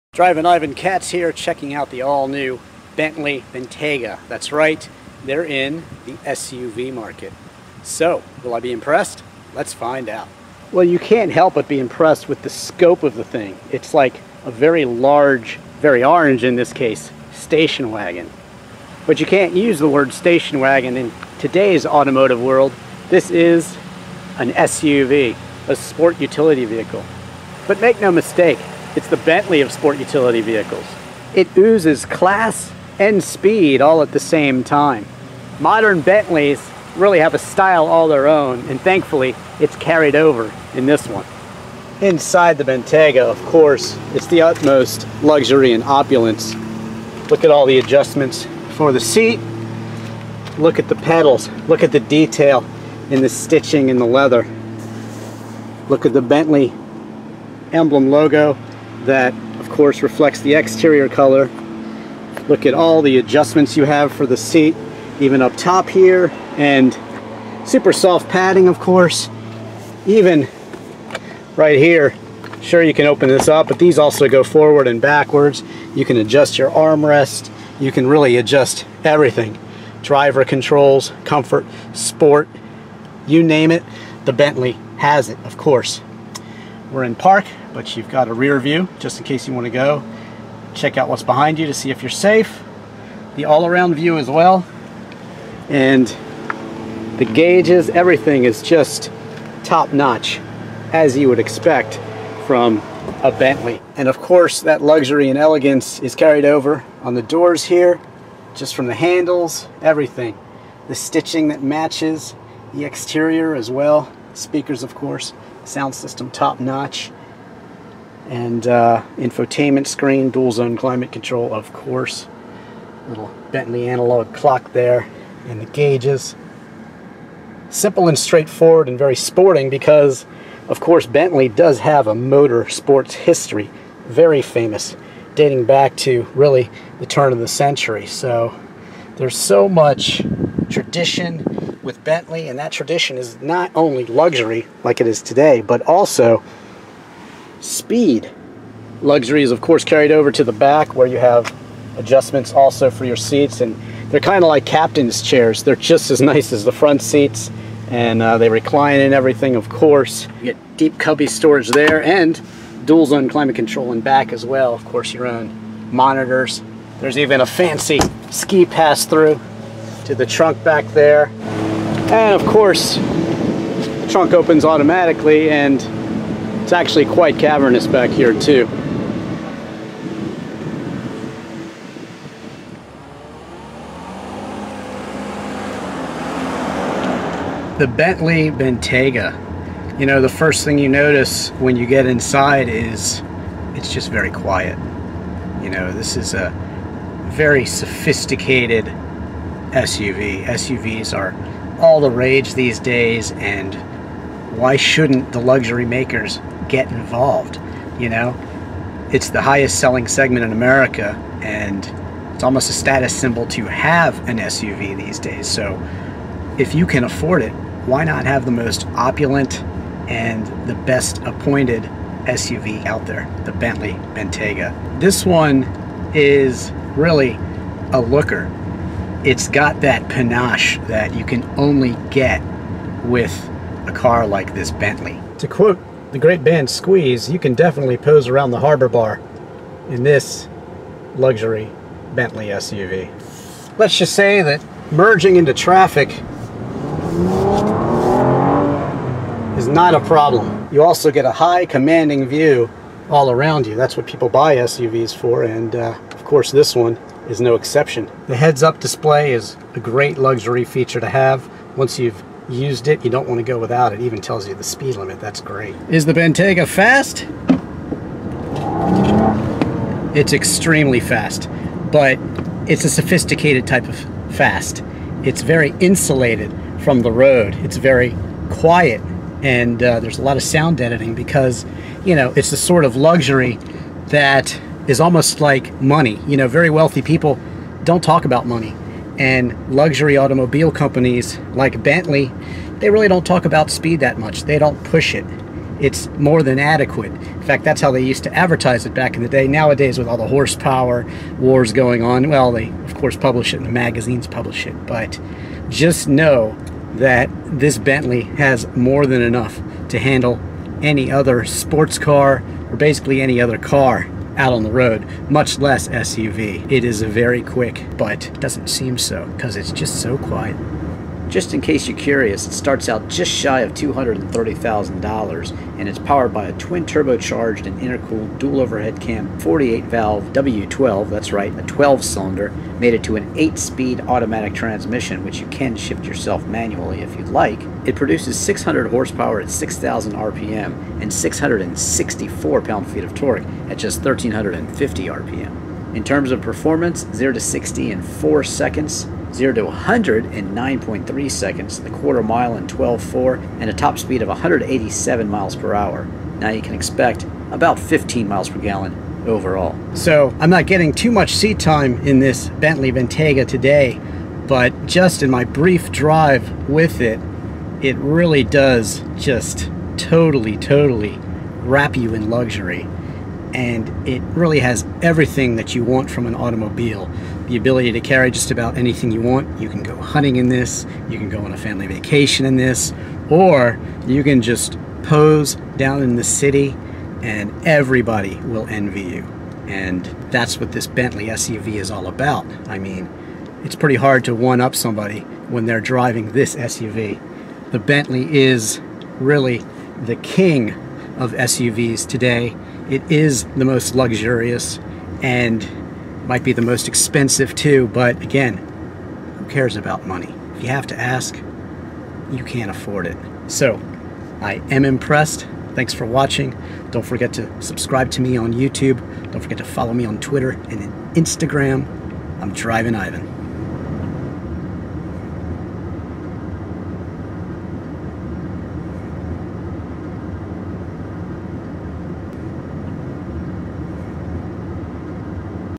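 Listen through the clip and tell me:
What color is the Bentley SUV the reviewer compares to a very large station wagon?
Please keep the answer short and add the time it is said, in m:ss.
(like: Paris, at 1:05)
Orange, at 0:15.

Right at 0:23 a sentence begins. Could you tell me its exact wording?
This is an SUV, a sport utility vehicle.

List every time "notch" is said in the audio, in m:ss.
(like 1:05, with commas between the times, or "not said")
1:39, 1:56.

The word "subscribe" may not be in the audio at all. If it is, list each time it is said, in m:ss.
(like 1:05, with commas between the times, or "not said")
6:57.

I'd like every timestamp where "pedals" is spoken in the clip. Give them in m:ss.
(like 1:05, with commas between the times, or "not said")
0:50.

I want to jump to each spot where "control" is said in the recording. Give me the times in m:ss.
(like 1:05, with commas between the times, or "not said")
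1:20, 2:01, 2:43.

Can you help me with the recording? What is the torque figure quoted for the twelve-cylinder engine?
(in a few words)
664 pound feet.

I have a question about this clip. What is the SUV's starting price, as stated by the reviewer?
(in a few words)
Just shy of $230,000.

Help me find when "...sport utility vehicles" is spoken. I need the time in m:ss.
0:29.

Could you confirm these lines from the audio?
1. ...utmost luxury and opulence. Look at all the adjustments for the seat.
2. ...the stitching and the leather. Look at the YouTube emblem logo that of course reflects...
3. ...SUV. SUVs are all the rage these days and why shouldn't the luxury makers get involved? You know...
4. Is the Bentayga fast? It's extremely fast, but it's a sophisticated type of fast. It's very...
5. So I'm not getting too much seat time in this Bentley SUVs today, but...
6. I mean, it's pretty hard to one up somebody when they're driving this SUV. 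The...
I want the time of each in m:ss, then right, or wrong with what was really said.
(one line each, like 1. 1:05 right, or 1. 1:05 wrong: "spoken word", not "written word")
1. 0:44 right
2. 0:53 wrong: "Bentley", not "YouTube"
3. 3:19 right
4. 4:25 right
5. 5:59 wrong: "Bentayga", not "SUVs"
6. 6:32 right.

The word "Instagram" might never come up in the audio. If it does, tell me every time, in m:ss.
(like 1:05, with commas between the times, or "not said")
7:01.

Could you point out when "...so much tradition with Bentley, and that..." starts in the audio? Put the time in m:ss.
2:19.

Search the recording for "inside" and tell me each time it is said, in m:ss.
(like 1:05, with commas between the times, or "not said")
0:42, 3:12.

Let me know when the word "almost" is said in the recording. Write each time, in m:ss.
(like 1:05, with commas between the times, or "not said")
3:32, 4:44.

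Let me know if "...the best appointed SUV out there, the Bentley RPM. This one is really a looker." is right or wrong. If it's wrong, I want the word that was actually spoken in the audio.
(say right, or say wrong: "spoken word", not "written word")
wrong: "Bentayga", not "RPM".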